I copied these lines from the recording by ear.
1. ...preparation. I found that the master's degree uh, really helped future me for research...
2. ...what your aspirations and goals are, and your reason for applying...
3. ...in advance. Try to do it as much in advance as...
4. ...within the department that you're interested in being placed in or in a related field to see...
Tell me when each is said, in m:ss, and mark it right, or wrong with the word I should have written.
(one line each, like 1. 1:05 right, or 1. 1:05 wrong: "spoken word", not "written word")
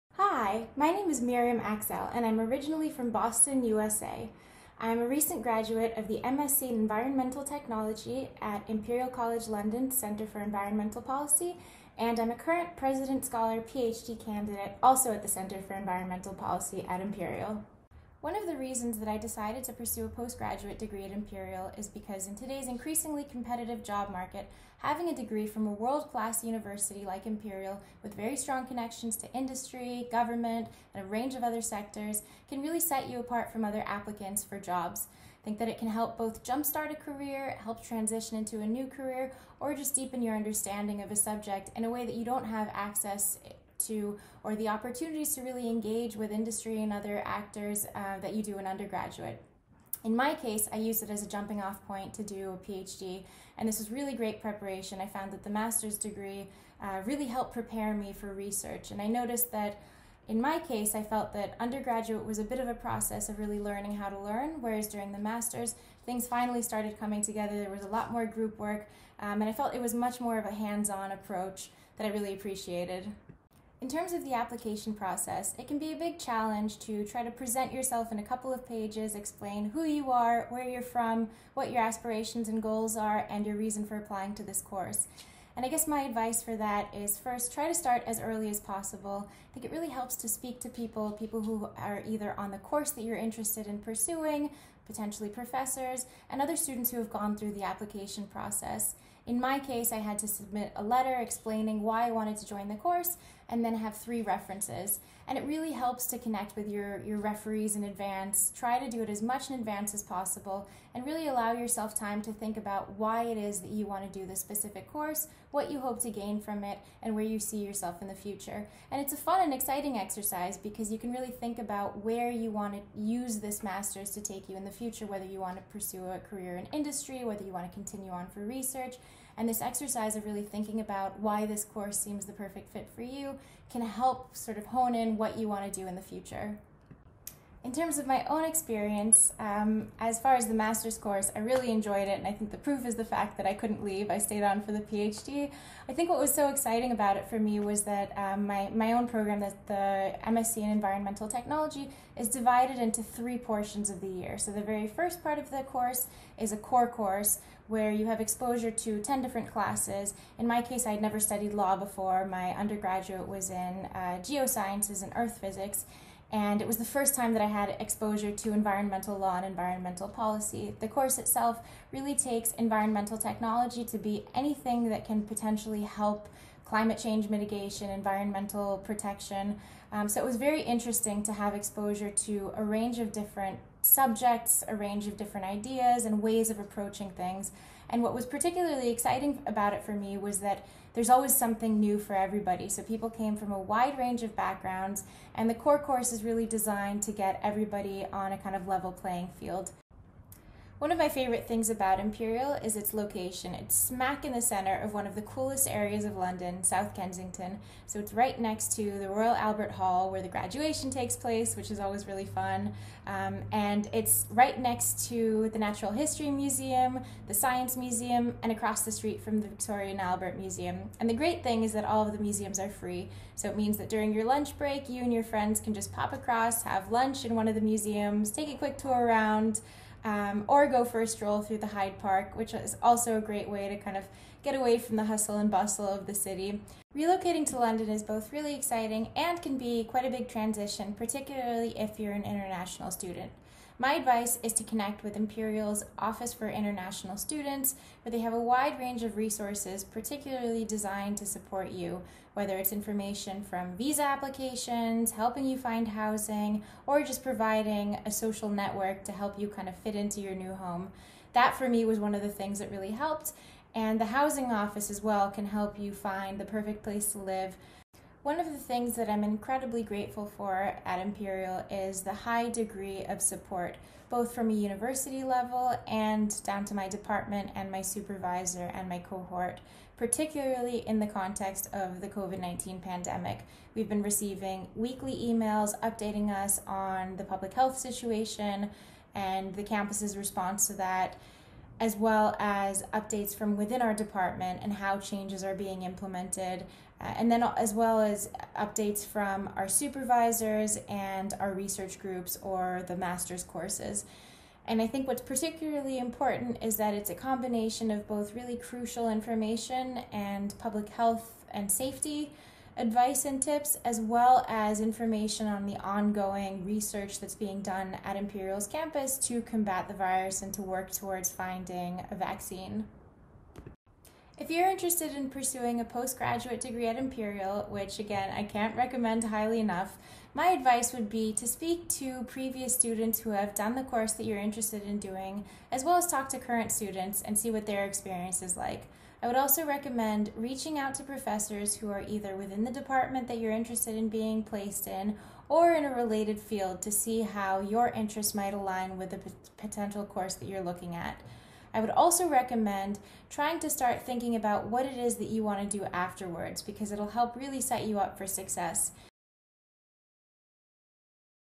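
1. 0:54 wrong: "prepare", not "future"
2. 1:21 right
3. 1:47 right
4. 5:42 right.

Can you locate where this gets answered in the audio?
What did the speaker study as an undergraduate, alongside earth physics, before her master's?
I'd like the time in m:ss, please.
2:44.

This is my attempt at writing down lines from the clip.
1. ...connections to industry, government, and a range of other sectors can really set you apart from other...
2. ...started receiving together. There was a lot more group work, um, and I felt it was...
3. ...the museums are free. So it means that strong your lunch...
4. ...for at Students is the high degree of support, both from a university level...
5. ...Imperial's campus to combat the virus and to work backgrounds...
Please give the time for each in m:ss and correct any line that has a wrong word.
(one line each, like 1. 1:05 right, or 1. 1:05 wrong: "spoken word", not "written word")
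1. 0:28 right
2. 1:06 wrong: "coming", not "receiving"
3. 3:42 wrong: "during", not "strong"
4. 4:30 wrong: "Imperial", not "Students"
5. 5:18 wrong: "towards", not "backgrounds".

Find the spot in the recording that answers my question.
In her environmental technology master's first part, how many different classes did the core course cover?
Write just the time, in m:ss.
2:39.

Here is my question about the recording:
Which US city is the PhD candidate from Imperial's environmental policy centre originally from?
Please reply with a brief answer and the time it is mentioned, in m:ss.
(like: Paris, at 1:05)
Boston, at 0:03.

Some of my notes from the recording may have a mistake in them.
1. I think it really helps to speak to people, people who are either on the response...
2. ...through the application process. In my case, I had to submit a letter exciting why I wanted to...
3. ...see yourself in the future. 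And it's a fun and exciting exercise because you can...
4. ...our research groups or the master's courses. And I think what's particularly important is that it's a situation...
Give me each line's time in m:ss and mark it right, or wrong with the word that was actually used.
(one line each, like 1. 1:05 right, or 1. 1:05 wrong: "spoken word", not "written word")
1. 1:29 wrong: "course", not "response"
2. 1:37 wrong: "explaining", not "exciting"
3. 1:57 right
4. 5:01 wrong: "combination", not "situation".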